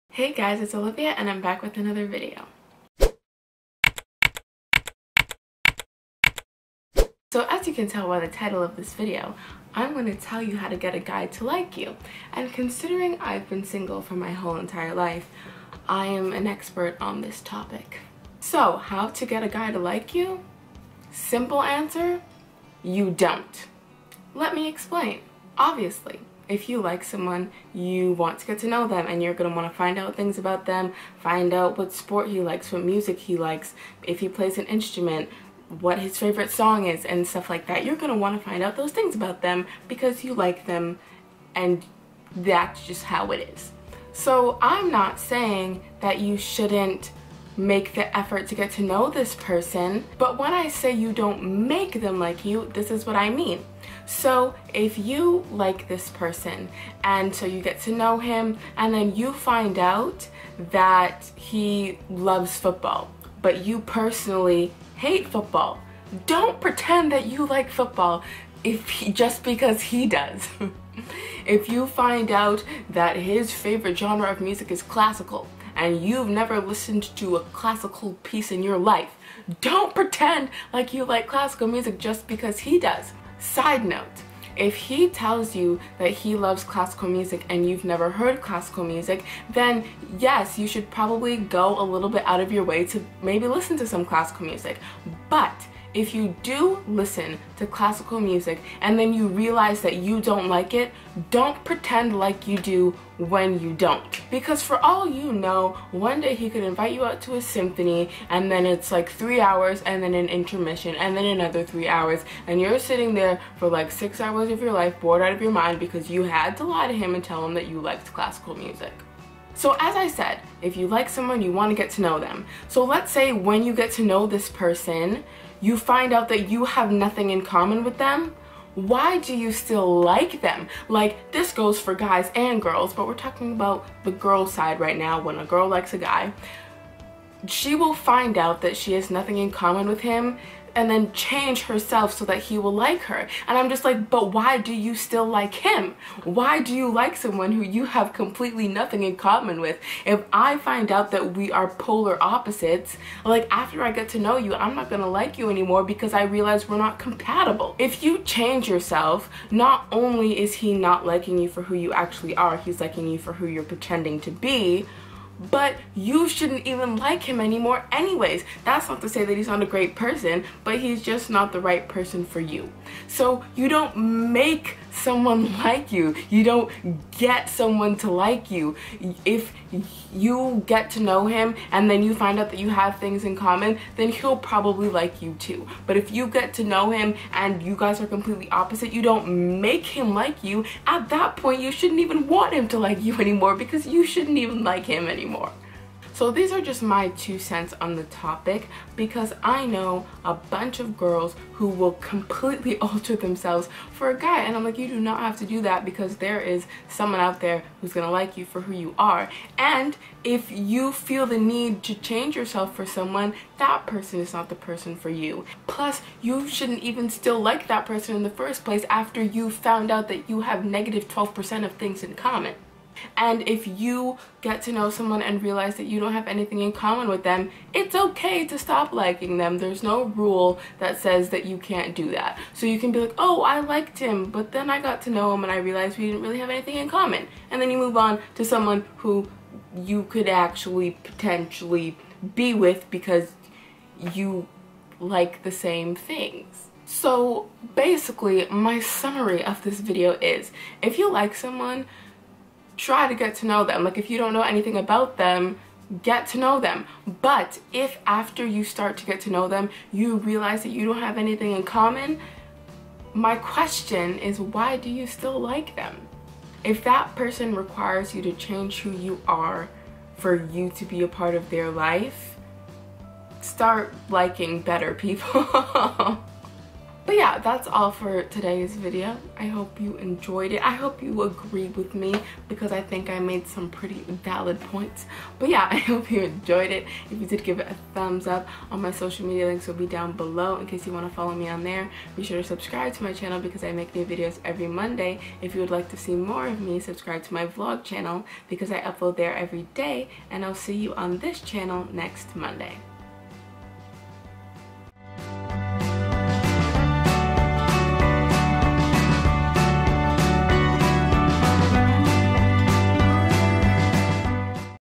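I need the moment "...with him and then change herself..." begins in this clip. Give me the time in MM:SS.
02:19.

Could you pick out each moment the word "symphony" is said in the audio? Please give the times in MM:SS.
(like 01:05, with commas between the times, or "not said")
01:47.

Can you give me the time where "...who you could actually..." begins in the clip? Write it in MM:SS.
03:58.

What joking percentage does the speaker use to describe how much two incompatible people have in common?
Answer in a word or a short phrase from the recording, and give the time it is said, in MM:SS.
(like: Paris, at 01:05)
-12%, at 03:40.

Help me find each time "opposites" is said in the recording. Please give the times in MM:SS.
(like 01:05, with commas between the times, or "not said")
02:32, 03:08.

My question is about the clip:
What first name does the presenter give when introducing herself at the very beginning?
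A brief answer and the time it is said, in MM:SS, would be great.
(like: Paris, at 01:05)
Olivia, at 00:00.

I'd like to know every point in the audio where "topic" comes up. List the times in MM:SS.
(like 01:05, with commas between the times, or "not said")
00:17, 03:18.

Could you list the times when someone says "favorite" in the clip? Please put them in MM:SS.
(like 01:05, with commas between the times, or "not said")
00:36, 01:13.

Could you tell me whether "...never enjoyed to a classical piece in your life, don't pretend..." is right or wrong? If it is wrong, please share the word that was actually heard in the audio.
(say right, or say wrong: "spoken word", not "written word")
wrong: "listened", not "enjoyed".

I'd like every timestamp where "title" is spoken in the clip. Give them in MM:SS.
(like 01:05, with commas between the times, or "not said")
00:08.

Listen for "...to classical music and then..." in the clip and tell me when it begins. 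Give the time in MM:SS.
01:37.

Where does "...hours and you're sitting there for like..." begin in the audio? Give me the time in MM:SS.
01:51.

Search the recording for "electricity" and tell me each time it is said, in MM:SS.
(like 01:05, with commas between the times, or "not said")
not said.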